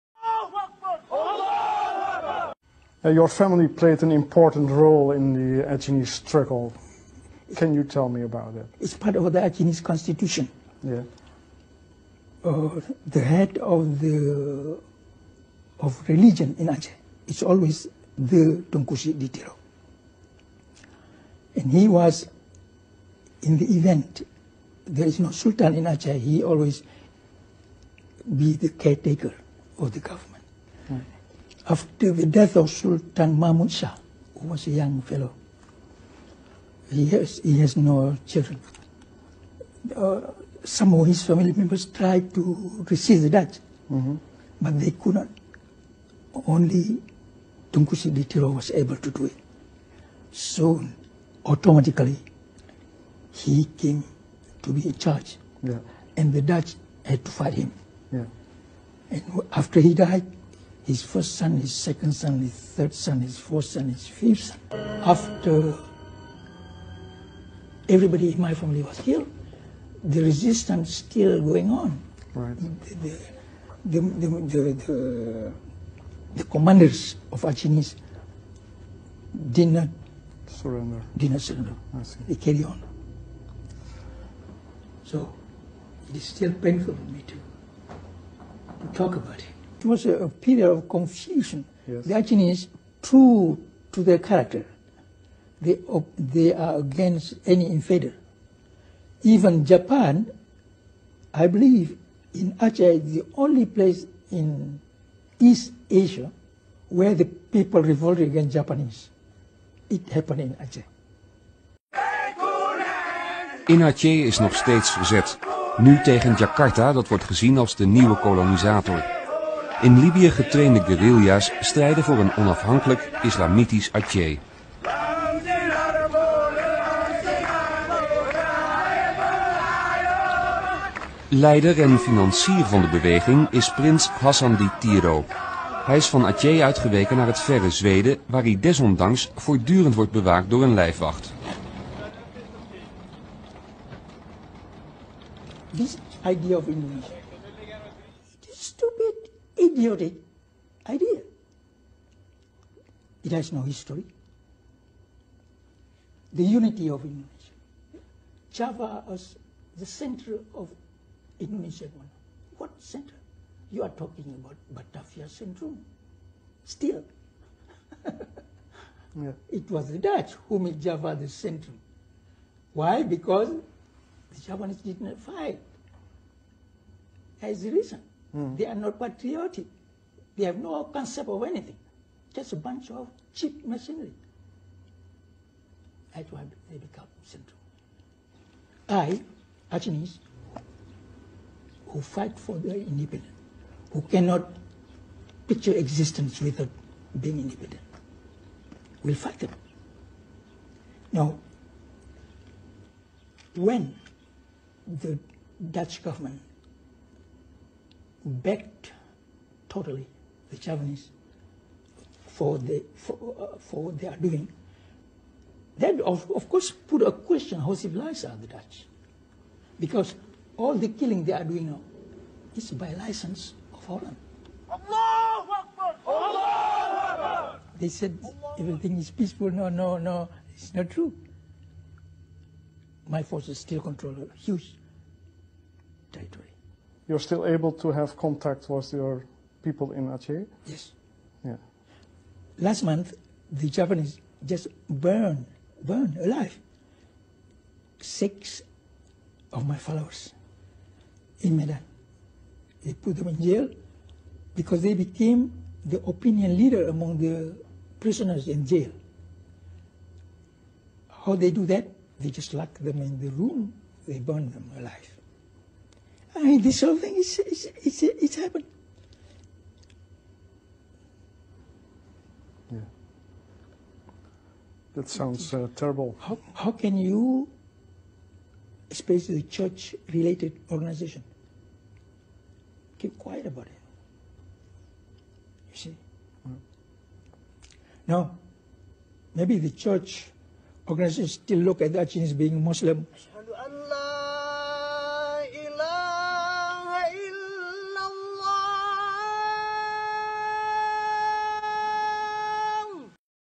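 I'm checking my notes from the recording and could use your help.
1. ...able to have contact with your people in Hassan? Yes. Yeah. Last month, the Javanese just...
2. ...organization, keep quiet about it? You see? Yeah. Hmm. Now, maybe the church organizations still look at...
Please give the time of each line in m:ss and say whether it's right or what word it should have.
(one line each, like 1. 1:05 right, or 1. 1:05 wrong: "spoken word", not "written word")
1. 3:57 wrong: "Aceh", not "Hassan"
2. 4:40 right.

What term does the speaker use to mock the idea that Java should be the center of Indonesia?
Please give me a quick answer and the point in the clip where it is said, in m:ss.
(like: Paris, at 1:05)
Batavia syndrome, at 2:44.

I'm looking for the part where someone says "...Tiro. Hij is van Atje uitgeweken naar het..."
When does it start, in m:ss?
2:14.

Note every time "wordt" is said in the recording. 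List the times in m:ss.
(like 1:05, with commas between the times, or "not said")
1:57, 2:19.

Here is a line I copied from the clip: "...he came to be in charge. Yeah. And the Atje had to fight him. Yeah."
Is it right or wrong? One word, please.
wrong.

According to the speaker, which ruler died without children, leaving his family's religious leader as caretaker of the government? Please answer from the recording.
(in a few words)
Sultan Mahmud Shah.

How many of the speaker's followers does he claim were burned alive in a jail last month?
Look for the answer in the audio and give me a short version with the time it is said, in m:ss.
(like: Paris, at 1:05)
6, at 4:07.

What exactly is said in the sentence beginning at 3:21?
Now, when the Dutch government backed totally the Javanese for, the, for, uh, for what they are doing.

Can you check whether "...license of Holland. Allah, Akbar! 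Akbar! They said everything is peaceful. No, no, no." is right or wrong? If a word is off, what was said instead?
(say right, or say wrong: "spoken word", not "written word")
right.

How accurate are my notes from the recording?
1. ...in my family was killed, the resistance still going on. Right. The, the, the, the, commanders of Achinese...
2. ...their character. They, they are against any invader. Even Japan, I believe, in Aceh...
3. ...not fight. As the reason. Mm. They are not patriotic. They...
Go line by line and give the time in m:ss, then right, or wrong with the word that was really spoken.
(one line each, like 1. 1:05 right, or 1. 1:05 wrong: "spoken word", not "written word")
1. 1:08 right
2. 1:34 right
3. 2:55 right.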